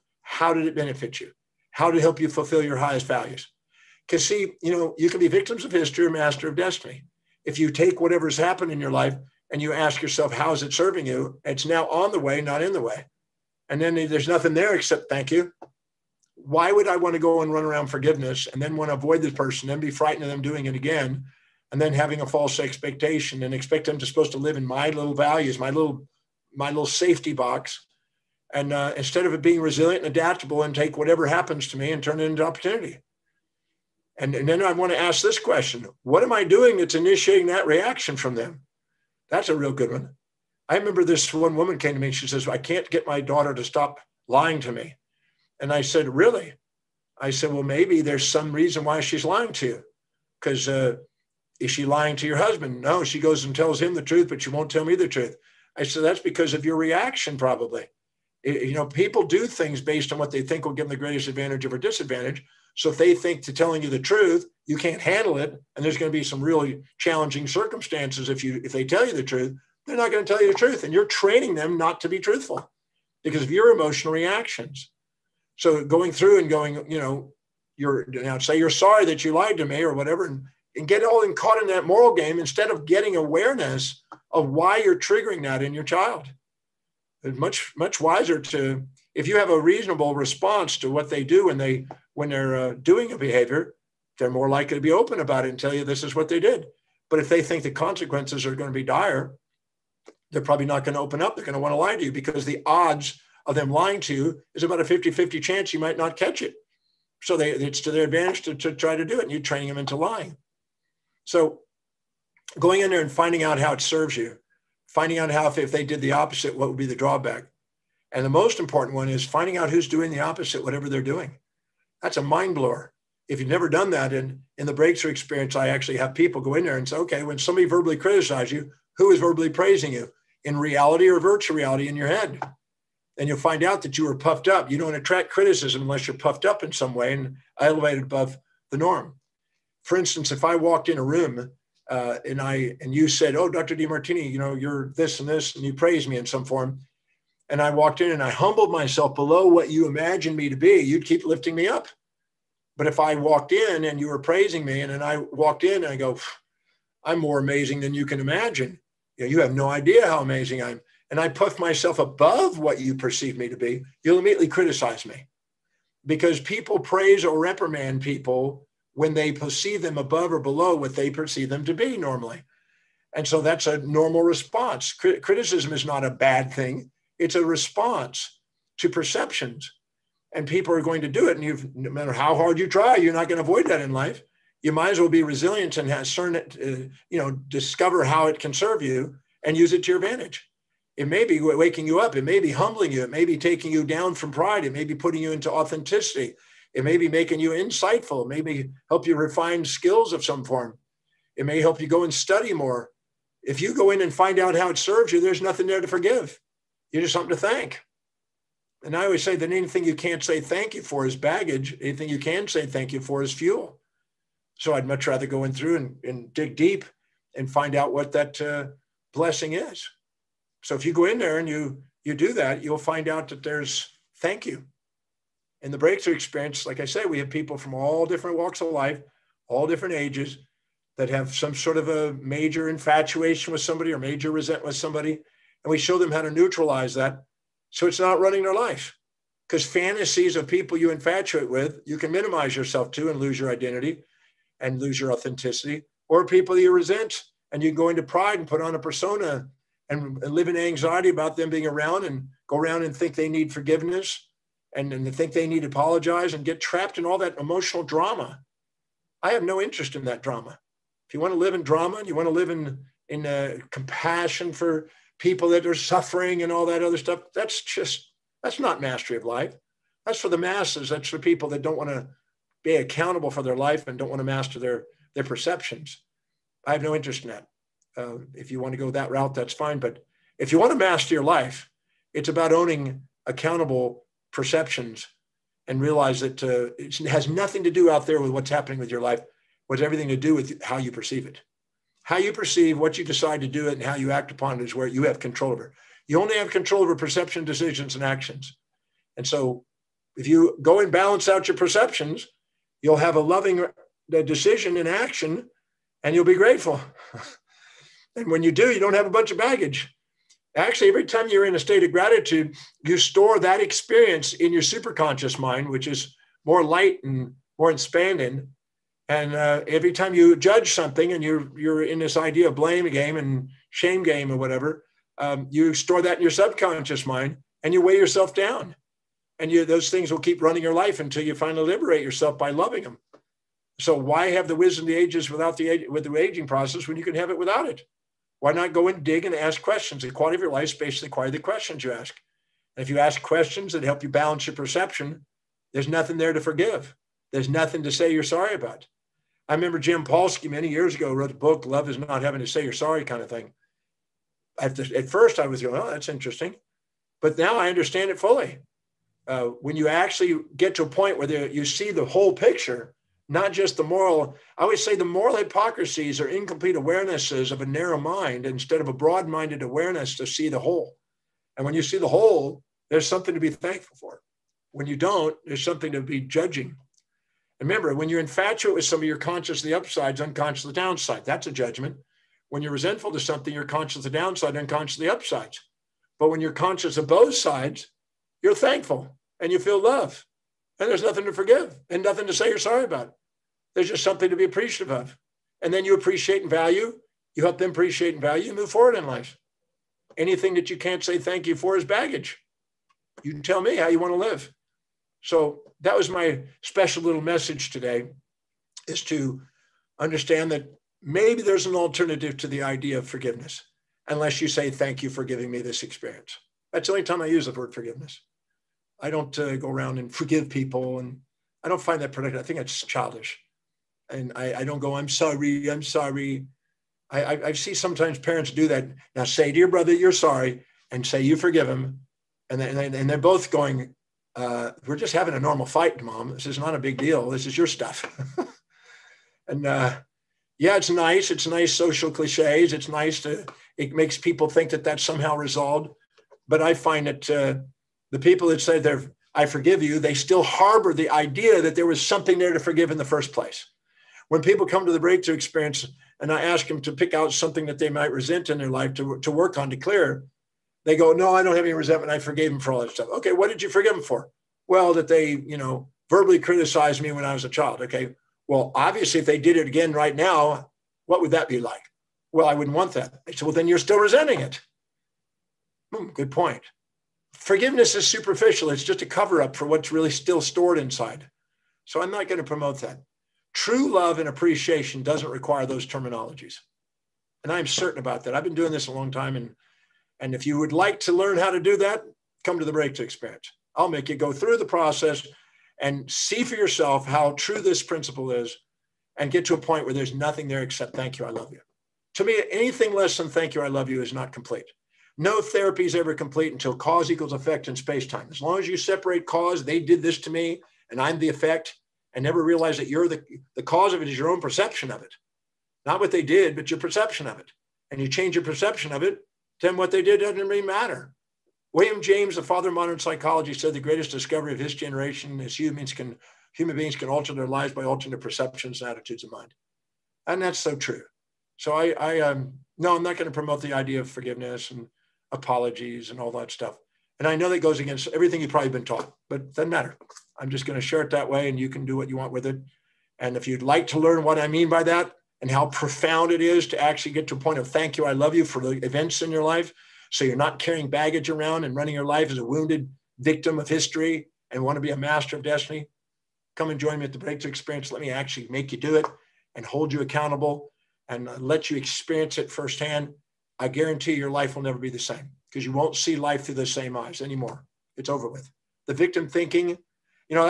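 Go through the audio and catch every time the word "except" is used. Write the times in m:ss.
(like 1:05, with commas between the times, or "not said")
0:14, 8:20.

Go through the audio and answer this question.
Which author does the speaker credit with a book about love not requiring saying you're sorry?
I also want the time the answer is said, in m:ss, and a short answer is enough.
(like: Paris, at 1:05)
Jim Paulsky, at 5:49.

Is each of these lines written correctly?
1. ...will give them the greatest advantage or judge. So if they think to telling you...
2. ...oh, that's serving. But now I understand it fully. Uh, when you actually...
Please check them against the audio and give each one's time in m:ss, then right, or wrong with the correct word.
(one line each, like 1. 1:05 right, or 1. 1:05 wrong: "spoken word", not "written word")
1. 1:00 wrong: "disadvantage", not "judge"
2. 5:55 wrong: "interesting", not "serving".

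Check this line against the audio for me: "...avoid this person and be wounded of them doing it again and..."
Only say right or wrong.
wrong.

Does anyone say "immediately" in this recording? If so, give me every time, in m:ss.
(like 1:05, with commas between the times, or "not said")
2:44.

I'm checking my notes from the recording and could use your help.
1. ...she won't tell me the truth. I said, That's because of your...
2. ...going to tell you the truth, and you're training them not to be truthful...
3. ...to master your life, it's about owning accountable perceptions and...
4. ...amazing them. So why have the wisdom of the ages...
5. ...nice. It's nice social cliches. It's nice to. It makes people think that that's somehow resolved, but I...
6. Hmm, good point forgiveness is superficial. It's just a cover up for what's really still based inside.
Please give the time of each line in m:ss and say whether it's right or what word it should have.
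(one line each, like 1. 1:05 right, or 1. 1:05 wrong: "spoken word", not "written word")
1. 0:54 right
2. 1:10 right
3. 4:40 right
4. 5:32 wrong: "loving", not "amazing"
5. 7:20 right
6. 7:55 wrong: "stored", not "based".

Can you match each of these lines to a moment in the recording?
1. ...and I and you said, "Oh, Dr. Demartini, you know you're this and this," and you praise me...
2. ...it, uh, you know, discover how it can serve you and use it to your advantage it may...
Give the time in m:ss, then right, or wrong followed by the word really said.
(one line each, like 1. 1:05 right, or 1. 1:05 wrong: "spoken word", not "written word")
1. 2:22 right
2. 3:06 right.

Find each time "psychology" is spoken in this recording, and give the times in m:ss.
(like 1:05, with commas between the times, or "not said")
8:42.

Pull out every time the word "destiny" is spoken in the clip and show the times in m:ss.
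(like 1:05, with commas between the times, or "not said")
0:06, 9:15.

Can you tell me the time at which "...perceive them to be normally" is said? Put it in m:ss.
2:51.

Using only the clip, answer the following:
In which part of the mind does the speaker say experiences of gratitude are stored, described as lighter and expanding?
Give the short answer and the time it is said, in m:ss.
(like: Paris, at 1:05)
Superconscious mind, at 5:14.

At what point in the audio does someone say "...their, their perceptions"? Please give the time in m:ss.
4:34.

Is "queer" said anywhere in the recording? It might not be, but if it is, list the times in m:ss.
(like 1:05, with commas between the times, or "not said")
not said.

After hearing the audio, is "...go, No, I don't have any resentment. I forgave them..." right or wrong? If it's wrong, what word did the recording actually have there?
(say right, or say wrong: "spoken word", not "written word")
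right.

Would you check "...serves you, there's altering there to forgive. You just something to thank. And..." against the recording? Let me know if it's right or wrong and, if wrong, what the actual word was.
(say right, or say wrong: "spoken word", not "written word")
wrong: "nothing", not "altering".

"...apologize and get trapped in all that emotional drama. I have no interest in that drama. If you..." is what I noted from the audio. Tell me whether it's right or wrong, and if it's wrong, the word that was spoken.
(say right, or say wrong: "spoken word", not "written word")
right.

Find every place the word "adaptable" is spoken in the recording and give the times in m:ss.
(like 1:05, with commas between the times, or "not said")
0:30.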